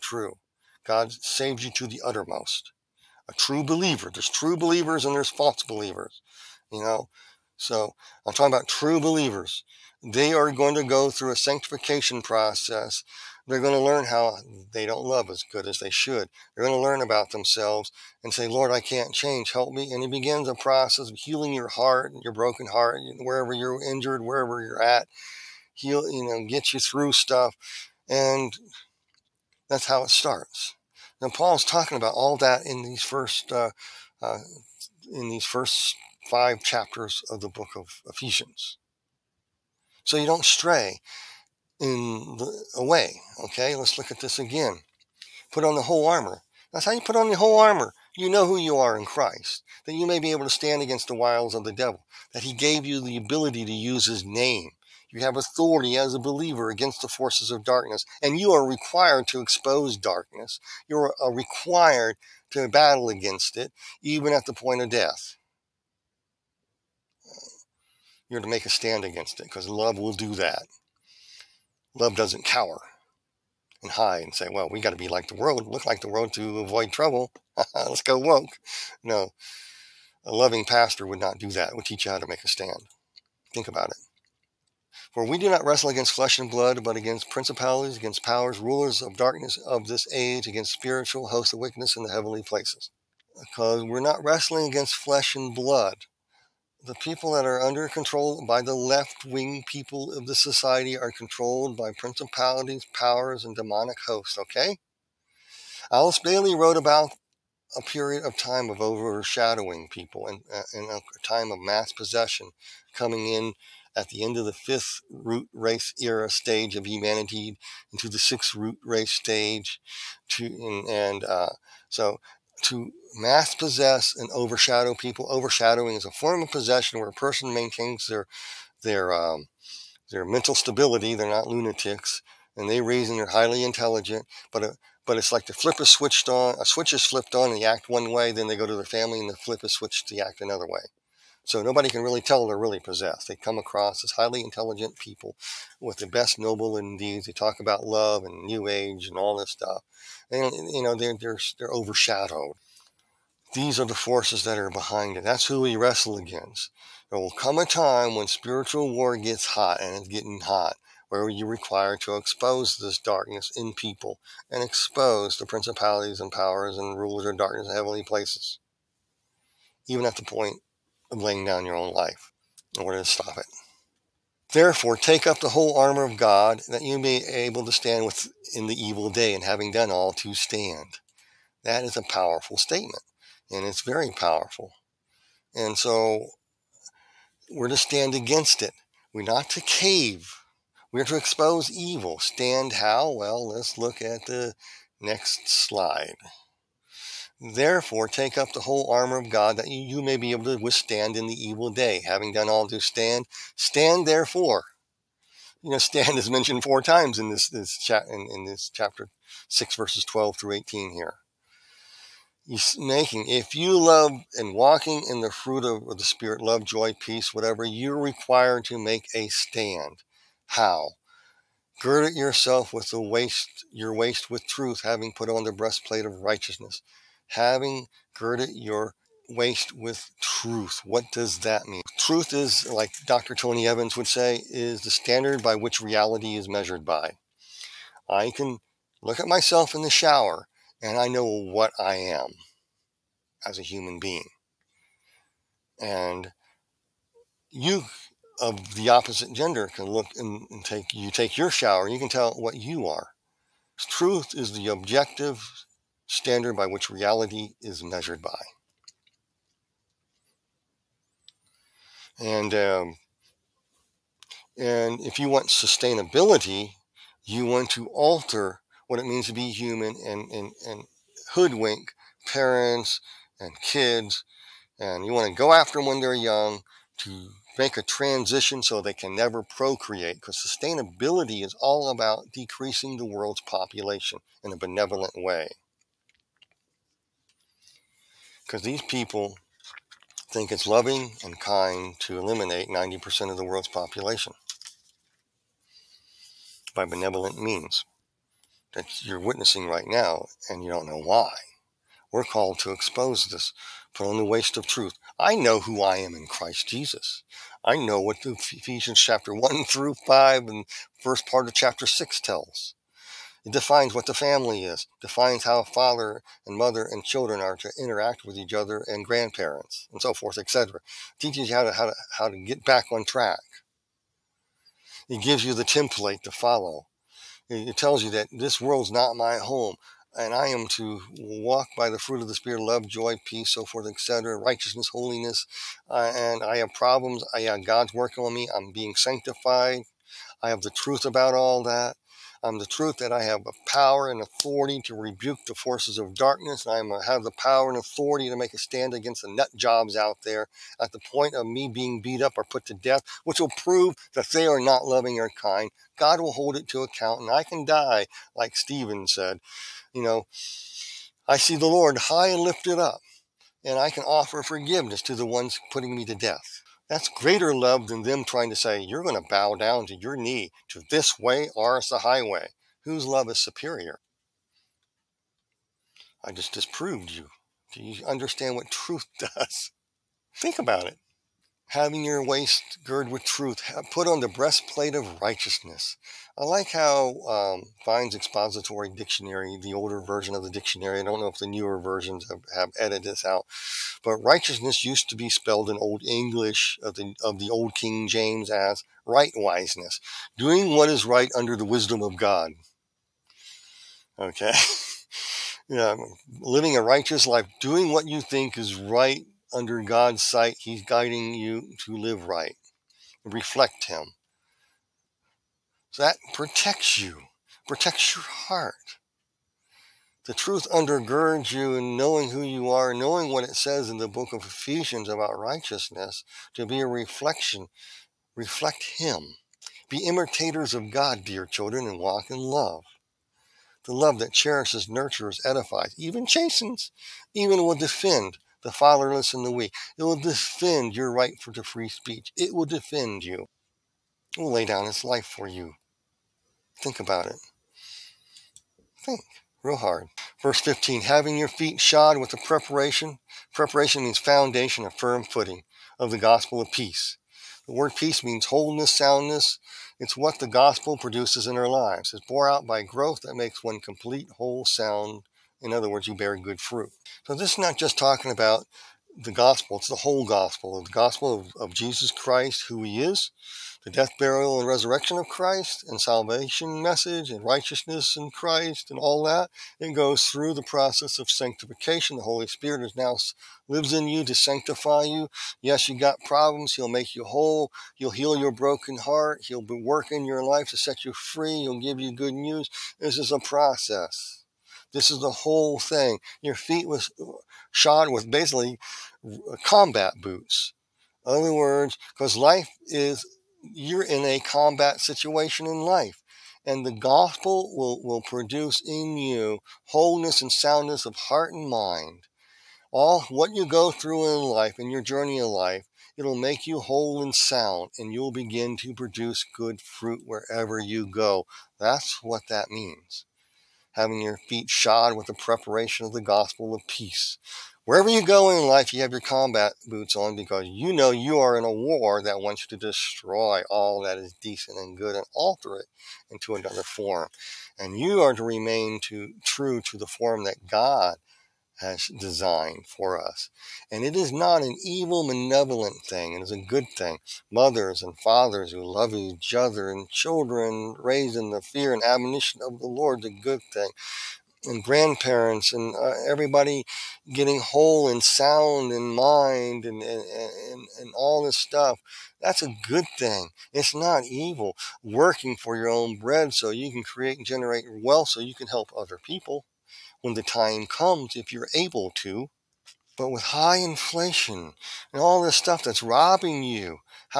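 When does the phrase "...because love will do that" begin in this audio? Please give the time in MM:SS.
01:09.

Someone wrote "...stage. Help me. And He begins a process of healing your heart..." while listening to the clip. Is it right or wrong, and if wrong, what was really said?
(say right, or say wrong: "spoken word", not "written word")
wrong: "change", not "stage".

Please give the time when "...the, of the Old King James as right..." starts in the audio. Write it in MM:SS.
06:36.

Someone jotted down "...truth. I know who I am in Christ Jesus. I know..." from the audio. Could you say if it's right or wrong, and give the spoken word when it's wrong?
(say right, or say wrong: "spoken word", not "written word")
right.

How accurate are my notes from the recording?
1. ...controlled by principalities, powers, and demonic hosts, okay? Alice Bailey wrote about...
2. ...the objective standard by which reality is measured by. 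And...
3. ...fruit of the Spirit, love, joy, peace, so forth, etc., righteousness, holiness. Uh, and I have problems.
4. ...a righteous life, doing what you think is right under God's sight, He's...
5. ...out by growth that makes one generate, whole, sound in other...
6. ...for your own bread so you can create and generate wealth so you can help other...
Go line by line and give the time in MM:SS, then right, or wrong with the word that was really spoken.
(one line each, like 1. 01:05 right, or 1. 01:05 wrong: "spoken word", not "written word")
1. 01:41 right
2. 04:14 right
3. 05:31 right
4. 06:46 right
5. 07:42 wrong: "complete", not "generate"
6. 09:25 right.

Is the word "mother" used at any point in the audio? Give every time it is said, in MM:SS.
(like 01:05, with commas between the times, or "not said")
05:16, 09:07.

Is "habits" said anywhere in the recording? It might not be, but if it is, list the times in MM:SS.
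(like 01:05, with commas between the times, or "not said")
not said.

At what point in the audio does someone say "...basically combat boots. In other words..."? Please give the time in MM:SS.
08:18.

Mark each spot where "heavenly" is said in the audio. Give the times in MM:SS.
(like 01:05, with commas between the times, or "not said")
01:32, 02:47.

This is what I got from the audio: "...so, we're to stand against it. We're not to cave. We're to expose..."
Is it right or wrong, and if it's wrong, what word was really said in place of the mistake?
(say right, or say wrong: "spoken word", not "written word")
right.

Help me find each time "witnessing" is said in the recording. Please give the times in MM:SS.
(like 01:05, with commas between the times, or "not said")
04:59.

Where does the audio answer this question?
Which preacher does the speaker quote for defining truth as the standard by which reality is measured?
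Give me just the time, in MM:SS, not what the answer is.
03:53.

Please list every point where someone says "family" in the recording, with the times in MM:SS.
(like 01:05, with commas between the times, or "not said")
02:18, 05:14.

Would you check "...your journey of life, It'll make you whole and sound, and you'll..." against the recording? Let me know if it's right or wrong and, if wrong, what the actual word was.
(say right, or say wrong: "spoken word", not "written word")
right.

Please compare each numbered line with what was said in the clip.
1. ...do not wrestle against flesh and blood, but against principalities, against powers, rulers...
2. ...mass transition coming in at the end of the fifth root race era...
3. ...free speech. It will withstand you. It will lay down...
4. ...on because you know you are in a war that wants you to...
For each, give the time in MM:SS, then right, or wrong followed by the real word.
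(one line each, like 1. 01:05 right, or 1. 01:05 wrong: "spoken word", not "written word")
1. 01:25 right
2. 01:51 wrong: "possession", not "transition"
3. 07:21 wrong: "defend", not "withstand"
4. 08:50 right.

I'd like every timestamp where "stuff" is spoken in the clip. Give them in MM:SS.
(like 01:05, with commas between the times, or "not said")
00:27, 02:29, 09:21, 09:35.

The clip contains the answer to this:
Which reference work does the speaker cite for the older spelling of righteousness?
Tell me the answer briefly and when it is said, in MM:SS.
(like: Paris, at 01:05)
Vine's expository dictionary, at 06:27.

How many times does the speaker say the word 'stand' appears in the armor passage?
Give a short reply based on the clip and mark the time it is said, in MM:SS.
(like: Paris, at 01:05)
4, at 03:26.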